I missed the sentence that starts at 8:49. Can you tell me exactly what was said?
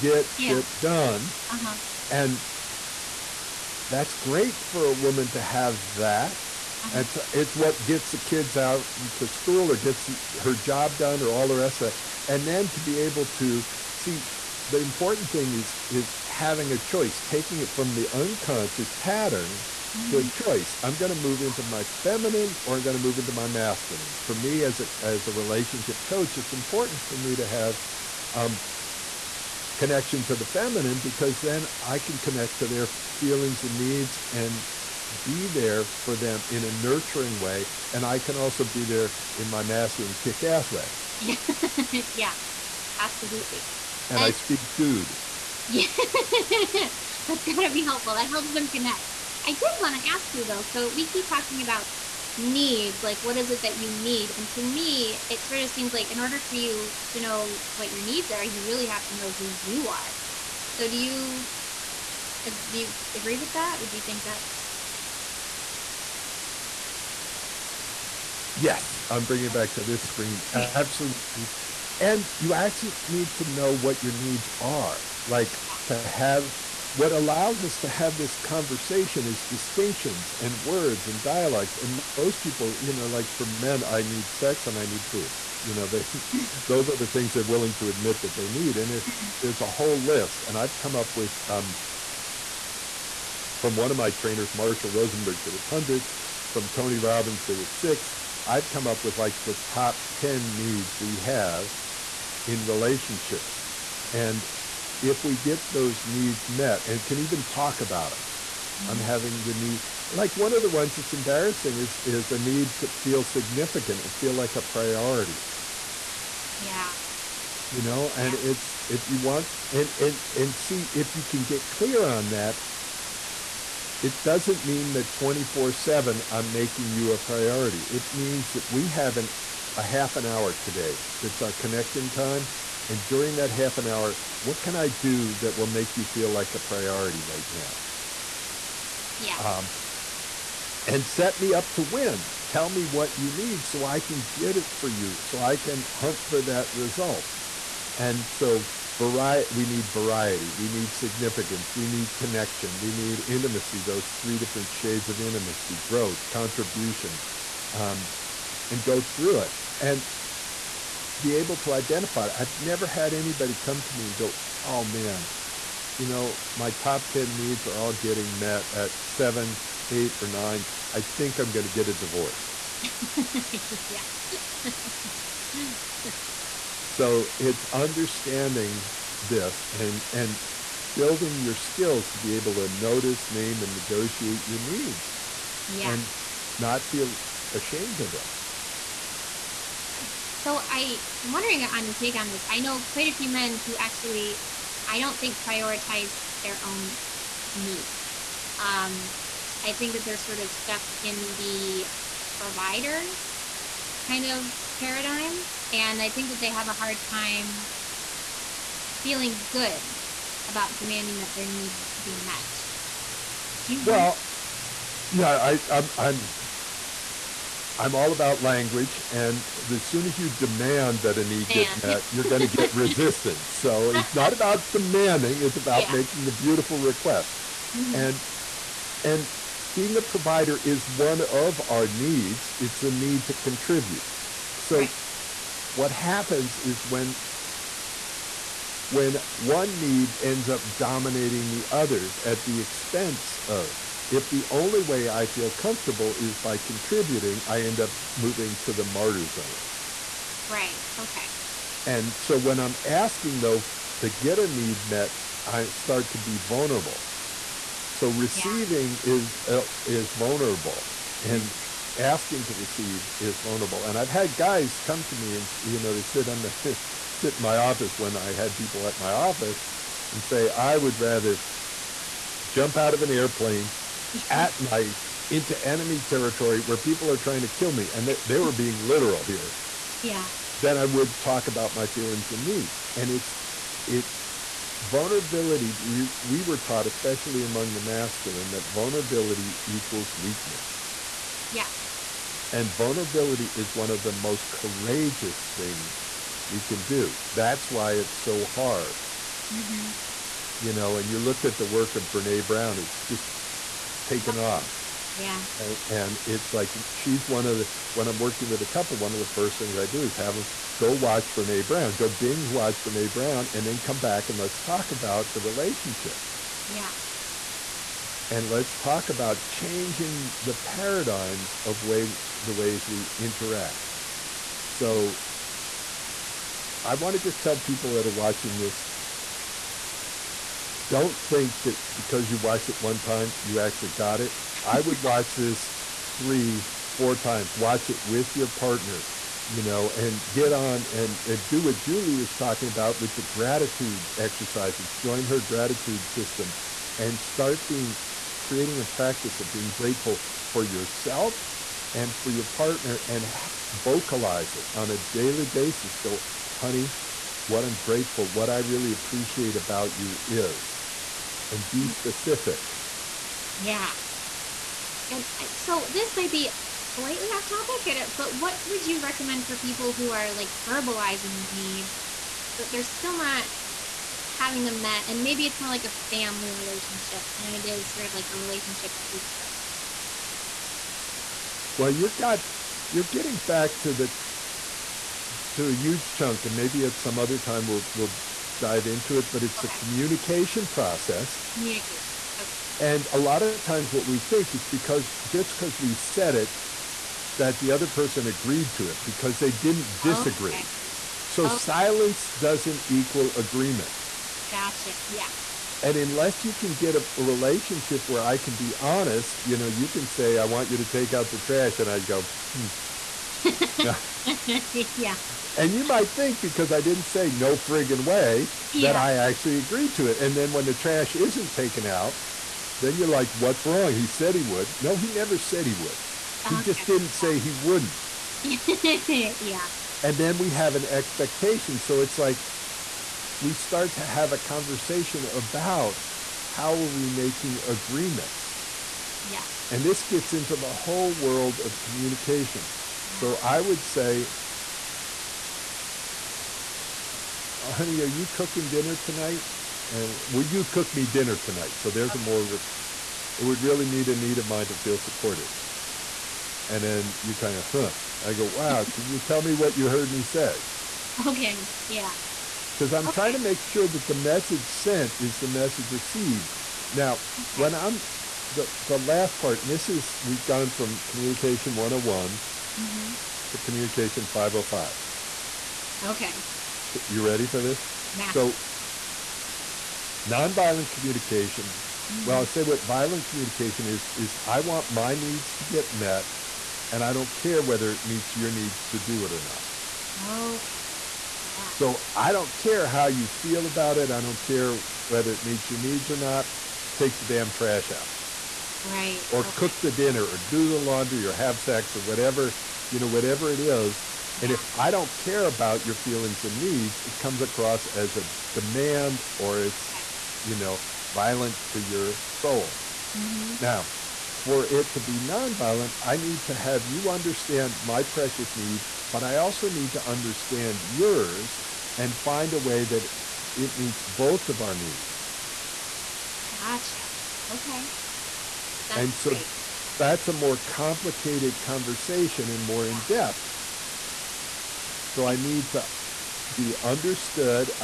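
that's a more complicated conversation and more yeah.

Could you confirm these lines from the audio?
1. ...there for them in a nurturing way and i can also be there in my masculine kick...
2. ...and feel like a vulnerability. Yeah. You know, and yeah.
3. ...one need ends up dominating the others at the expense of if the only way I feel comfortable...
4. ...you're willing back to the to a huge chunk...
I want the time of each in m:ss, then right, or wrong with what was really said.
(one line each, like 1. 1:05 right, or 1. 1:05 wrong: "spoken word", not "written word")
1. 0:35 right
2. 1:54 wrong: "priority", not "vulnerability"
3. 3:59 right
4. 6:22 wrong: "getting", not "willing".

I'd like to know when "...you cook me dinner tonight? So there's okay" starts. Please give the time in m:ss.
7:30.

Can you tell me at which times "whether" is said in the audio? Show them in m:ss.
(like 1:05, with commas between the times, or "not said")
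8:07, 8:15.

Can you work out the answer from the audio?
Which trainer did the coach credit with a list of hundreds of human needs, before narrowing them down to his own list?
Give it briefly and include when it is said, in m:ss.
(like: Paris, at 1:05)
Marshall Rosenberg, at 1:34.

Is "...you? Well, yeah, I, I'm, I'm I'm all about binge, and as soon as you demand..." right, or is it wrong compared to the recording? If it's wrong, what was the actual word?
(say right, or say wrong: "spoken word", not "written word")
wrong: "language", not "binge".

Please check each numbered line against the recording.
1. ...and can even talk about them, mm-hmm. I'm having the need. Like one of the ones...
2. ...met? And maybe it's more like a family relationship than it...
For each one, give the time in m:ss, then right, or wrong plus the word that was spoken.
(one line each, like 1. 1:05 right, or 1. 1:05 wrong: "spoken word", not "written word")
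1. 1:46 right
2. 6:14 right.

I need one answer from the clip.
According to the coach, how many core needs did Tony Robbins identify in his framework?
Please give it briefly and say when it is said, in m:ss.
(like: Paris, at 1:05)
6, at 1:37.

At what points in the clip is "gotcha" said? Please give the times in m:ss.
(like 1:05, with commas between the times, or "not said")
6:44, 8:46.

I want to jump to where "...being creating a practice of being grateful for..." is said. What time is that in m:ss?
5:47.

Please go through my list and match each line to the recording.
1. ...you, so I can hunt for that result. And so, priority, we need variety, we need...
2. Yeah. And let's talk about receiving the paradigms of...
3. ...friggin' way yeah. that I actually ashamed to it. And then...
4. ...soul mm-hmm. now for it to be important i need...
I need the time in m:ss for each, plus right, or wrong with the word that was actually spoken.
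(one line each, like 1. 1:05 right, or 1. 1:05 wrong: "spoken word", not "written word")
1. 2:24 wrong: "variety", not "priority"
2. 5:16 wrong: "changing", not "receiving"
3. 6:57 wrong: "agreed", not "ashamed"
4. 8:32 wrong: "nonviolent", not "important".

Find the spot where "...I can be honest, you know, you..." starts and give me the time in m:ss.
6:48.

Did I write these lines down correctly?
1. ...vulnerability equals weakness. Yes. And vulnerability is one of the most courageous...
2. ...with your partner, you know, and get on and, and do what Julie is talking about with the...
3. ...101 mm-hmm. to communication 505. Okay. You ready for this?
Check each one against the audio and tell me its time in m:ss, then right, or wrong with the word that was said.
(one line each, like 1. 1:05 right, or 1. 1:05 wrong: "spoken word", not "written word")
1. 4:48 right
2. 5:38 right
3. 7:51 right.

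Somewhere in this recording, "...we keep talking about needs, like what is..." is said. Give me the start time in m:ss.
0:50.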